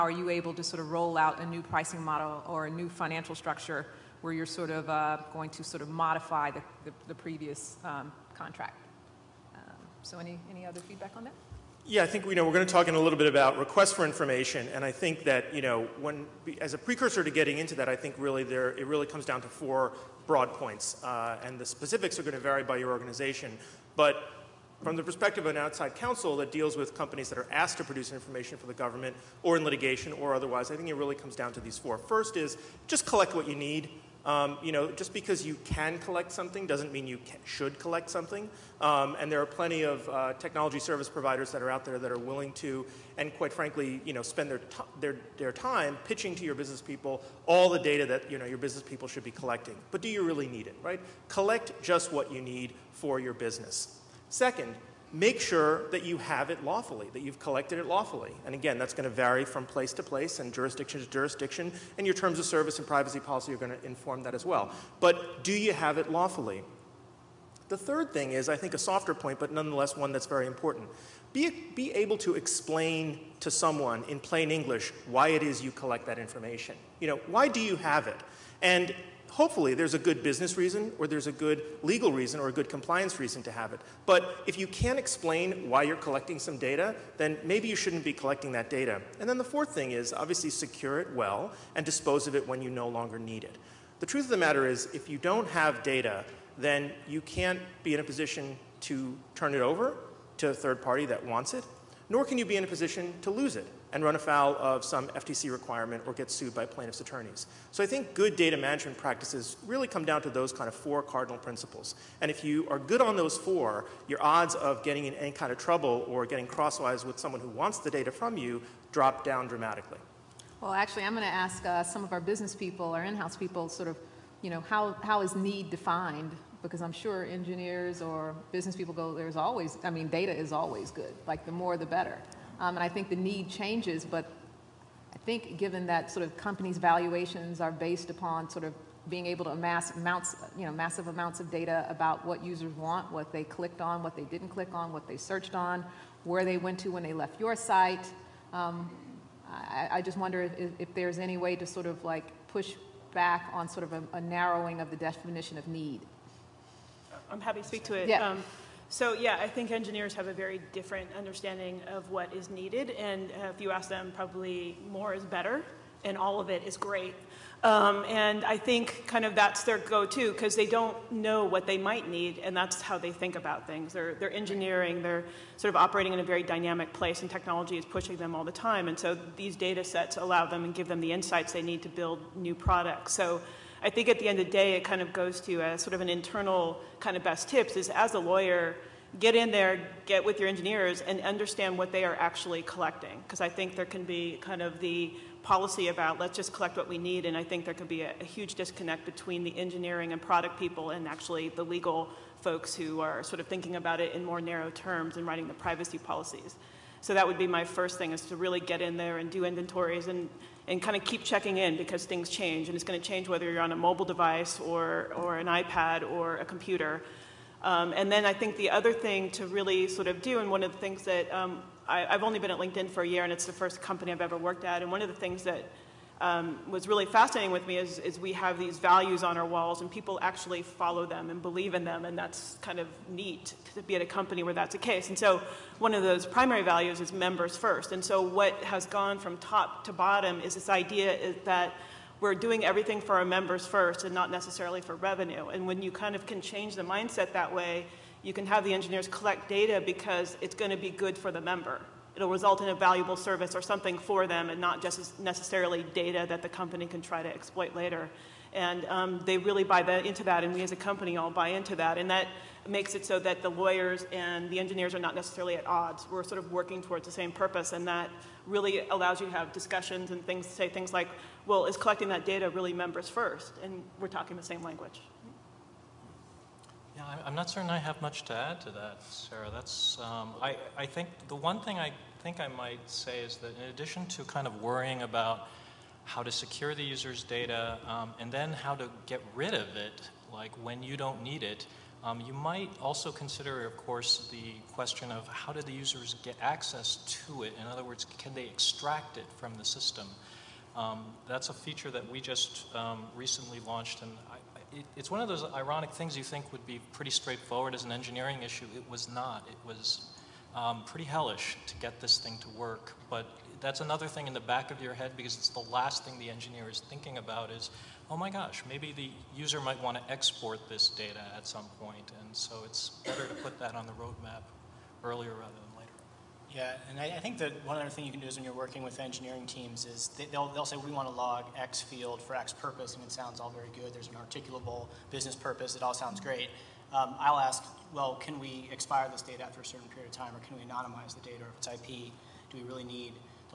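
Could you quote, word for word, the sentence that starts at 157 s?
I'm happy to speak to it.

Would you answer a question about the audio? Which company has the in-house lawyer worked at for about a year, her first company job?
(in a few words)
LinkedIn.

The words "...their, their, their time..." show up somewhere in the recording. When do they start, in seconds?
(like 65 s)
44 s.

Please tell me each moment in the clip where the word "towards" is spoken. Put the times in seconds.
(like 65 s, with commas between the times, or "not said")
266 s.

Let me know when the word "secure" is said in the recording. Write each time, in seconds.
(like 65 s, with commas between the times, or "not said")
90 s, 286 s.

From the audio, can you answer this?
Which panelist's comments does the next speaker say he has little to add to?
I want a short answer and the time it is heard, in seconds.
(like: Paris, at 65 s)
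Sarah, at 279 s.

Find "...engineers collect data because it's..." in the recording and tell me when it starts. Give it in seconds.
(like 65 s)
248 s.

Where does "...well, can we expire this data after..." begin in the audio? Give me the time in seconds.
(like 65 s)
337 s.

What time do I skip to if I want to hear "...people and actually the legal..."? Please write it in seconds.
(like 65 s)
200 s.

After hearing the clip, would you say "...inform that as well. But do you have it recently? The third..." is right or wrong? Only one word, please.
wrong.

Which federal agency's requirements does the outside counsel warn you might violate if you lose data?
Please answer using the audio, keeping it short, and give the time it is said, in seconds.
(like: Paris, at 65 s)
FTC, at 105 s.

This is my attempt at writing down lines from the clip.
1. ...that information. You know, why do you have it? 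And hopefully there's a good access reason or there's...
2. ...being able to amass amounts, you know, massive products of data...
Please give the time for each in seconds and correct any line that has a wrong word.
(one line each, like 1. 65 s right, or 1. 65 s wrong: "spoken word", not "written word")
1. 76 s wrong: "business", not "access"
2. 139 s wrong: "amounts", not "products".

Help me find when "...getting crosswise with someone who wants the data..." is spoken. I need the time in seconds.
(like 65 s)
116 s.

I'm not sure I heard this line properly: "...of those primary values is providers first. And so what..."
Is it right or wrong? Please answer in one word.
wrong.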